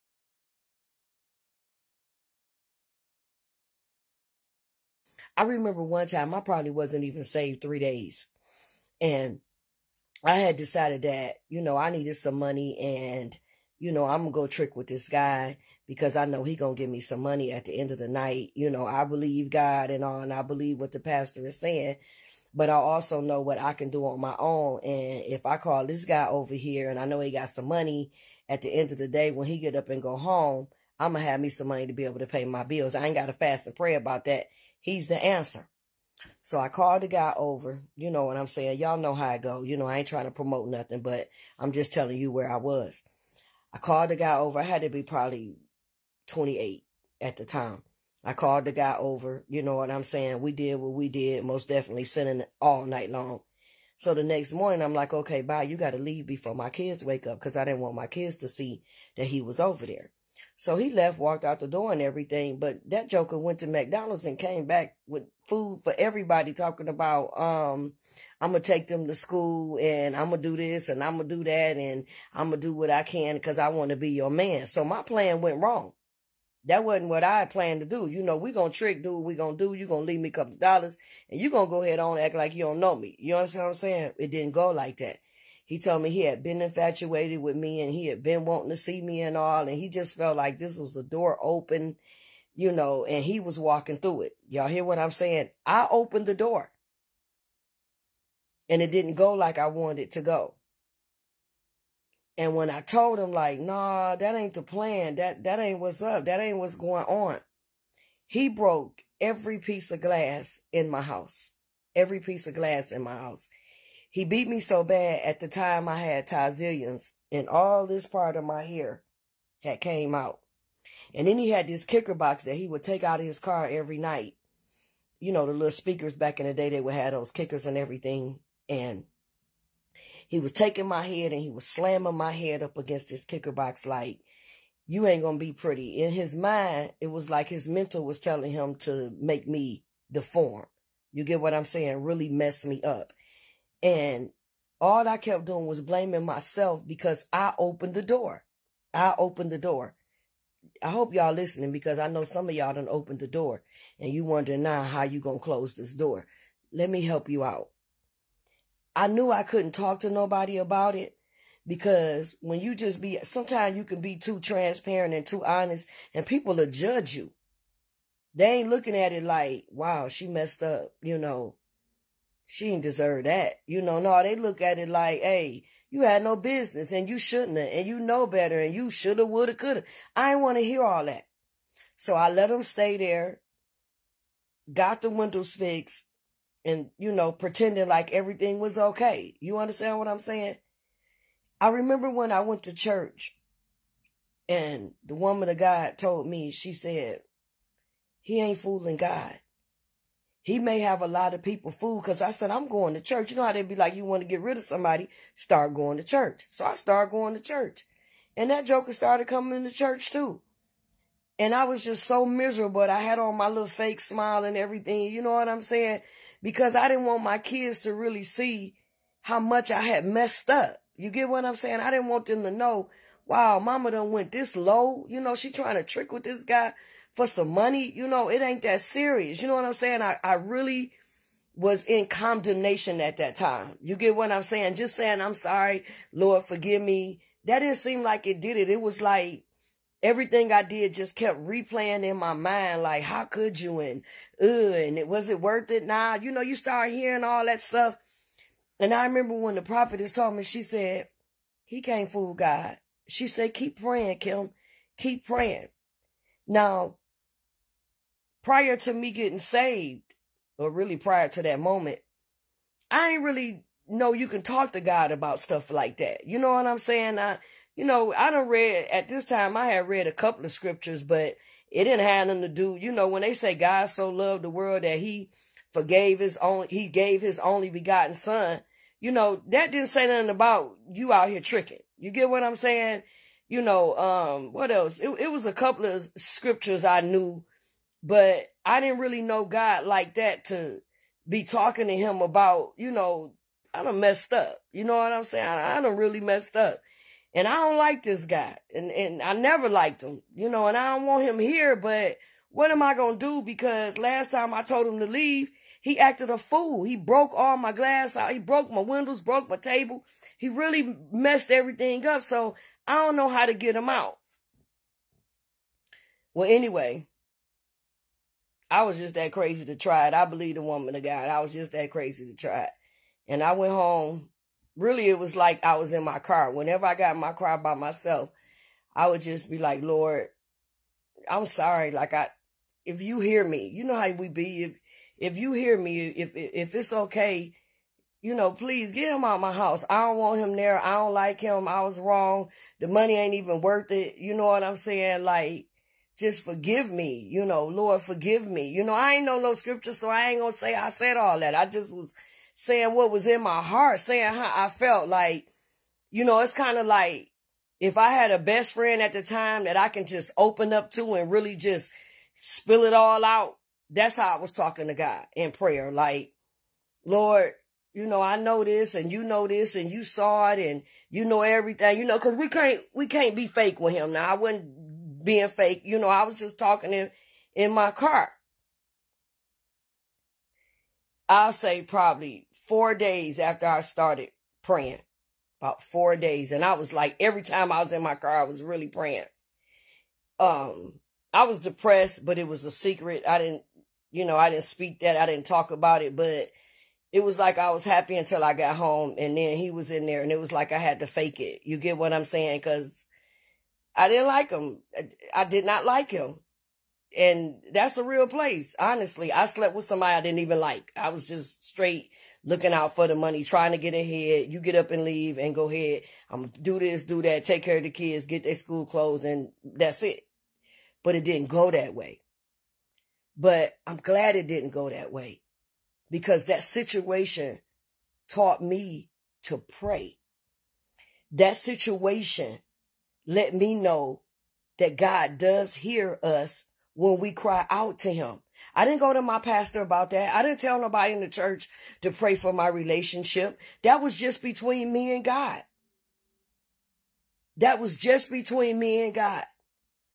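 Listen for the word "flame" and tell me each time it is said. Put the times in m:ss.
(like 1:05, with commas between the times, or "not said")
not said.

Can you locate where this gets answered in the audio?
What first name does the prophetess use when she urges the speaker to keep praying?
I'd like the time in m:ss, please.
4:14.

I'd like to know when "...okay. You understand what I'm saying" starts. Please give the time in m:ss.
3:08.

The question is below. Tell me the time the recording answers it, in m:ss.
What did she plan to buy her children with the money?
6:58.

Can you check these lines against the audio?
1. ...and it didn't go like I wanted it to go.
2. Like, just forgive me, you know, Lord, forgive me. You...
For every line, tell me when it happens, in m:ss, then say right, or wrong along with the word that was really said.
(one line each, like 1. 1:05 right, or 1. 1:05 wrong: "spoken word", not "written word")
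1. 1:38 right
2. 5:45 right.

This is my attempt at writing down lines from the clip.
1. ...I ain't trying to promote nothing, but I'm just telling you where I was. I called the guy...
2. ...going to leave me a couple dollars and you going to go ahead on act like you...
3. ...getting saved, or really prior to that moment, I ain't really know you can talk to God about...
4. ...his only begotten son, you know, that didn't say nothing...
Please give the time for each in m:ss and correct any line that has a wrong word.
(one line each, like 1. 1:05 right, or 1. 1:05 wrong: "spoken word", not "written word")
1. 0:39 right
2. 1:19 right
3. 4:19 right
4. 4:37 right.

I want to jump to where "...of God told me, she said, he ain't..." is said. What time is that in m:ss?
3:15.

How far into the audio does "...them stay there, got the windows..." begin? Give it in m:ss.
3:02.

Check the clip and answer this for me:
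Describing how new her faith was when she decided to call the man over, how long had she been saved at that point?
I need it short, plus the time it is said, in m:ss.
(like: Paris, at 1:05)
3 days, at 0:07.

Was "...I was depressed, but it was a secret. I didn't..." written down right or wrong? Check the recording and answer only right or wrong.
right.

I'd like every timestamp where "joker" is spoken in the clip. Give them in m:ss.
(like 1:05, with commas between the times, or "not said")
1:03, 3:28.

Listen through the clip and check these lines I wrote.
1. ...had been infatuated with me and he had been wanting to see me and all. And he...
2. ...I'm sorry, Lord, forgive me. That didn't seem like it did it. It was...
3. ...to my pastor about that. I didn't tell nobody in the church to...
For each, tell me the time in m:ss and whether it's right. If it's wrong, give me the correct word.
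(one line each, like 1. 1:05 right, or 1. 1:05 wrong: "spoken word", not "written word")
1. 1:26 right
2. 3:55 right
3. 7:19 right.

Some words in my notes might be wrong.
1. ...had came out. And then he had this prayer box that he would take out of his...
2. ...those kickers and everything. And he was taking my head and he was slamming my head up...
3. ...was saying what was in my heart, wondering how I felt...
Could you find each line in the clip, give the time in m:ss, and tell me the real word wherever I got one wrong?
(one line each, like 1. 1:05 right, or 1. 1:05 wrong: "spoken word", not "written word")
1. 1:59 wrong: "kicker", not "prayer"
2. 2:07 right
3. 5:51 wrong: "saying", not "wondering".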